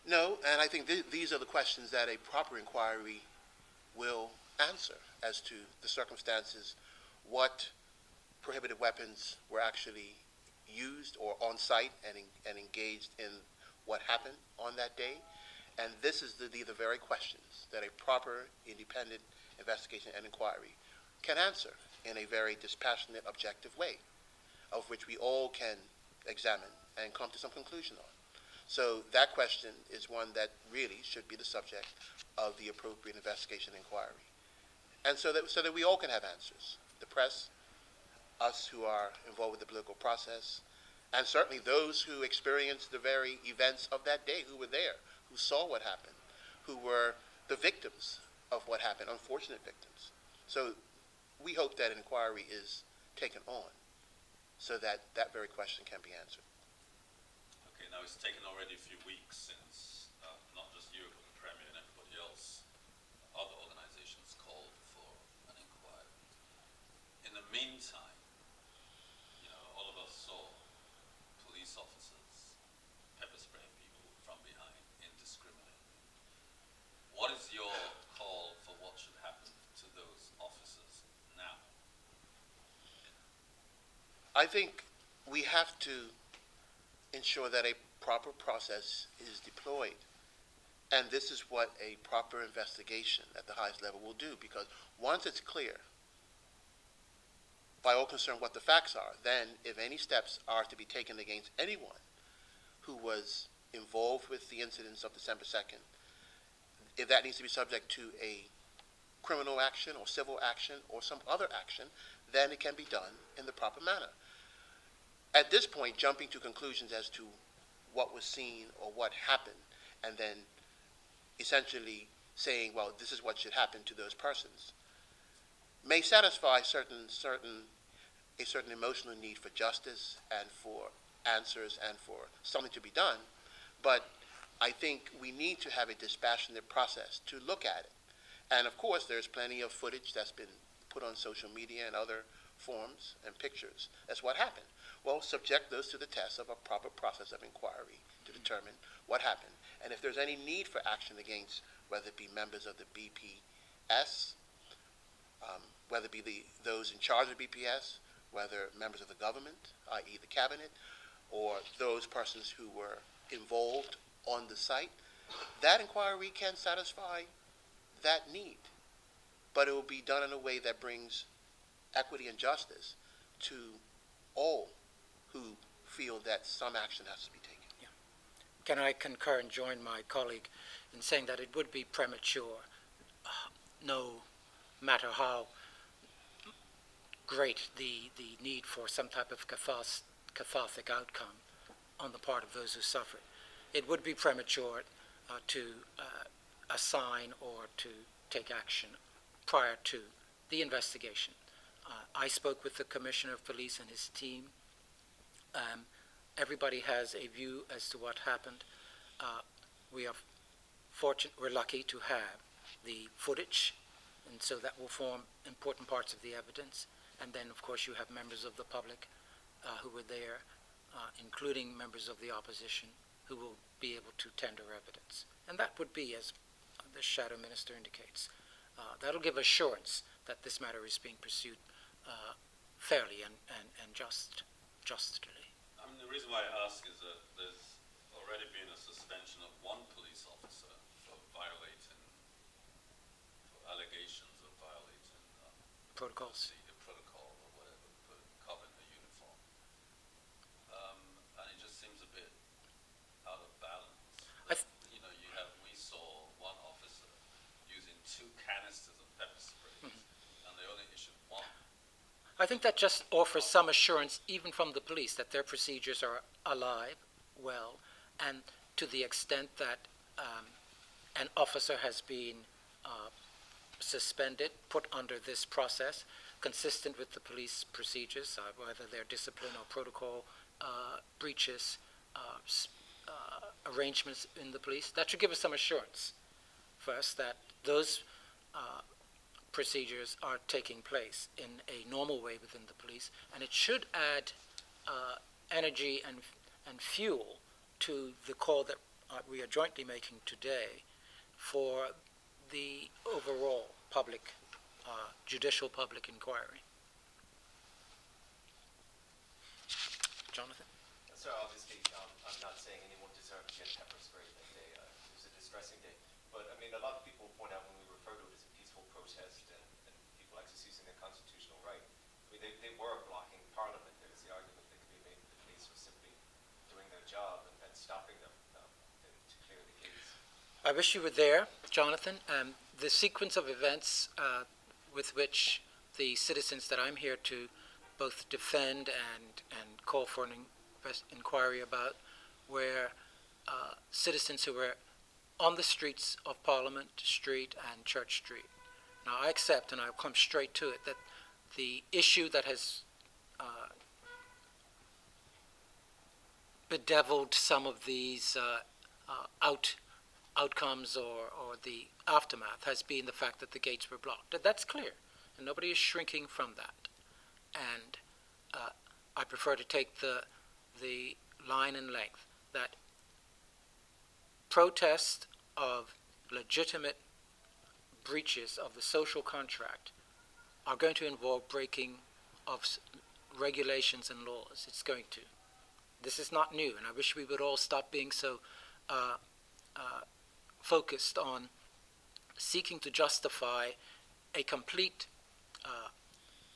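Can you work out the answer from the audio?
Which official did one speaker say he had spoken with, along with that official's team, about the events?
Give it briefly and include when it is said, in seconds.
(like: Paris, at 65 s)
Commissioner of Police, at 202 s.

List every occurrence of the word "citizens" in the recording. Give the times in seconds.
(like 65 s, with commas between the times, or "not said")
336 s, 343 s.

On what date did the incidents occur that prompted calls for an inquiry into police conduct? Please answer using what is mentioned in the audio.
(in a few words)
December 2nd.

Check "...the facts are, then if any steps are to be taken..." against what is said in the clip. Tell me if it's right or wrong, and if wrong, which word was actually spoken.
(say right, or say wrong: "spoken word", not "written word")
right.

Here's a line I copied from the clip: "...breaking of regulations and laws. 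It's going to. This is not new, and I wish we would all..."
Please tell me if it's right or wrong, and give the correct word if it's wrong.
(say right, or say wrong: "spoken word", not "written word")
right.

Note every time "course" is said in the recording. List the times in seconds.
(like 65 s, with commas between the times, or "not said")
138 s, 217 s.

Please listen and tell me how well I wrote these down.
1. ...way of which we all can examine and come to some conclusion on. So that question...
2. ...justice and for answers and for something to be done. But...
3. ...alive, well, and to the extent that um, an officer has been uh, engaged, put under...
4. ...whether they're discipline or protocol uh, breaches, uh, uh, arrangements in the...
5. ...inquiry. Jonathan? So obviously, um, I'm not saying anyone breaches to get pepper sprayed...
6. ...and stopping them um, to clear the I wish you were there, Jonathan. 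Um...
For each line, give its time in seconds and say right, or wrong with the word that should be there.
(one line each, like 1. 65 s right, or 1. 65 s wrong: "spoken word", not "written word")
1. 23 s right
2. 129 s right
3. 266 s wrong: "suspended", not "engaged"
4. 278 s right
5. 306 s wrong: "deserves", not "breaches"
6. 327 s right.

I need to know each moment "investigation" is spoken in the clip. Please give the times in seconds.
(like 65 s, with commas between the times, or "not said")
19 s, 33 s, 92 s, 200 s.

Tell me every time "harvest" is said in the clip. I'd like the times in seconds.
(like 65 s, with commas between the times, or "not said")
not said.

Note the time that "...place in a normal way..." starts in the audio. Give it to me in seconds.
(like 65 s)
290 s.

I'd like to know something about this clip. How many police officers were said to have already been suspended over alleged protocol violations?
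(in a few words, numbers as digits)
1.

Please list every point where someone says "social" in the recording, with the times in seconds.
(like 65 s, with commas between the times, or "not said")
141 s, 378 s.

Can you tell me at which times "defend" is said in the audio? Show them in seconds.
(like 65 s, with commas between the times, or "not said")
338 s.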